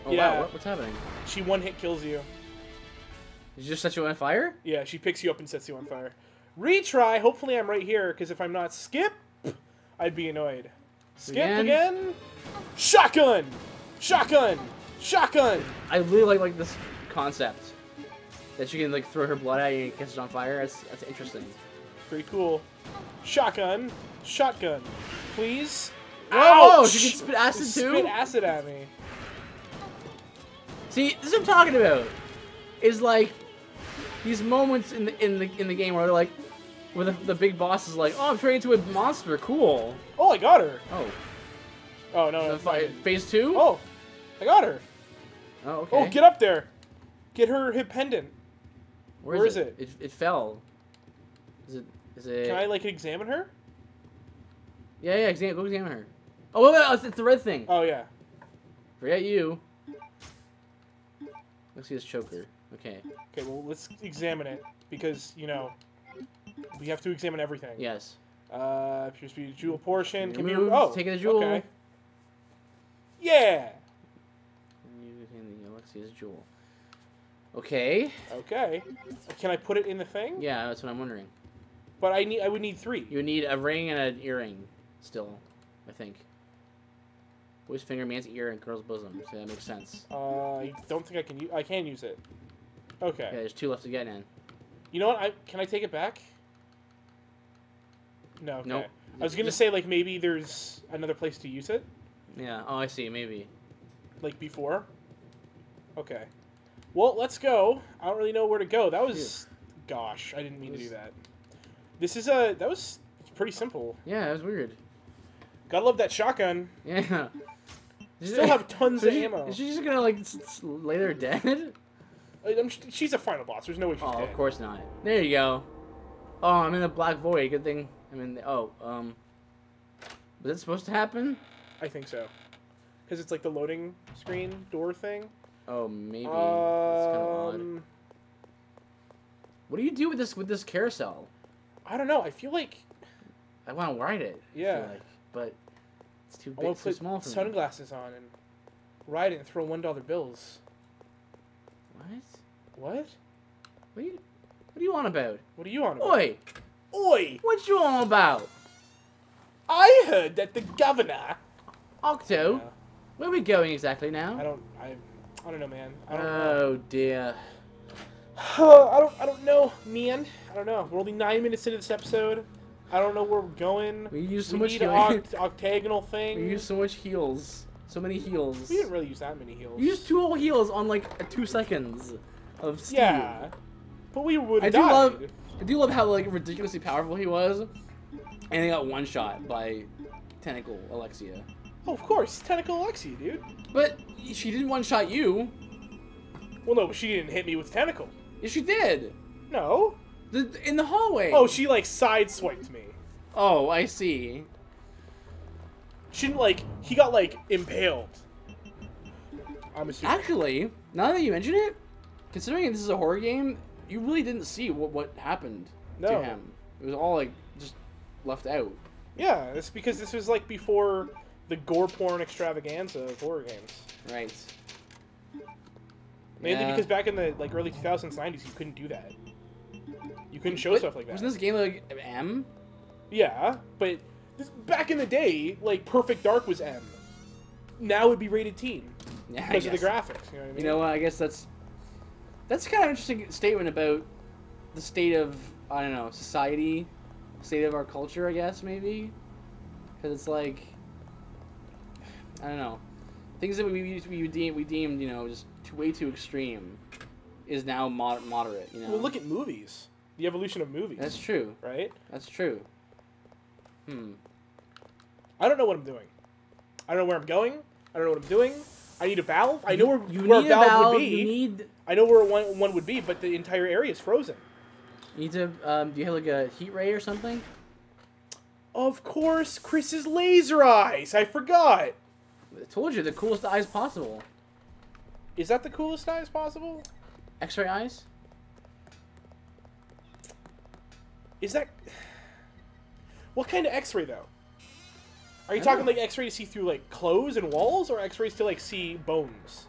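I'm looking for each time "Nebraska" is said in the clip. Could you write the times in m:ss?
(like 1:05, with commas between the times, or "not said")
not said.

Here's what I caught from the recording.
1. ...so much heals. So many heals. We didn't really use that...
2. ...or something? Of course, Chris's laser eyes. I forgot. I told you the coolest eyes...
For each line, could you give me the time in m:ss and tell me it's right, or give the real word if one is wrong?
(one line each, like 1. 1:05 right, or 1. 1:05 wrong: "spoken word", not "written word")
1. 2:56 right
2. 4:36 right.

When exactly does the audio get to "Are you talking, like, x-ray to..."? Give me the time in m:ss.
4:55.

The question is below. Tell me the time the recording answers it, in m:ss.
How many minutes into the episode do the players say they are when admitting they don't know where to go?
2:51.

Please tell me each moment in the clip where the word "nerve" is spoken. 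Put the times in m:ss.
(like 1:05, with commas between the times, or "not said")
not said.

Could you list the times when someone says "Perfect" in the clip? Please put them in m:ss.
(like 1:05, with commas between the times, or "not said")
3:55.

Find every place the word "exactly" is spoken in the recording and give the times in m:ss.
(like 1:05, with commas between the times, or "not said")
2:43.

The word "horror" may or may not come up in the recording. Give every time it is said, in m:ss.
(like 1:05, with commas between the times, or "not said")
3:32, 3:43.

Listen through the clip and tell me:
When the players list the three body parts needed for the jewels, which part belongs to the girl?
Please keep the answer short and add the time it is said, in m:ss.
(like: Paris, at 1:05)
Bosom, at 1:28.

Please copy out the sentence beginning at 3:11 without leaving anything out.
Oh, of course, Tentacle Alexia, dude.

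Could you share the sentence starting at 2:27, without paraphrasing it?
on and ride it and throw one dollar bills.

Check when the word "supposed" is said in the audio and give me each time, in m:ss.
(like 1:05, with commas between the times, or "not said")
2:10.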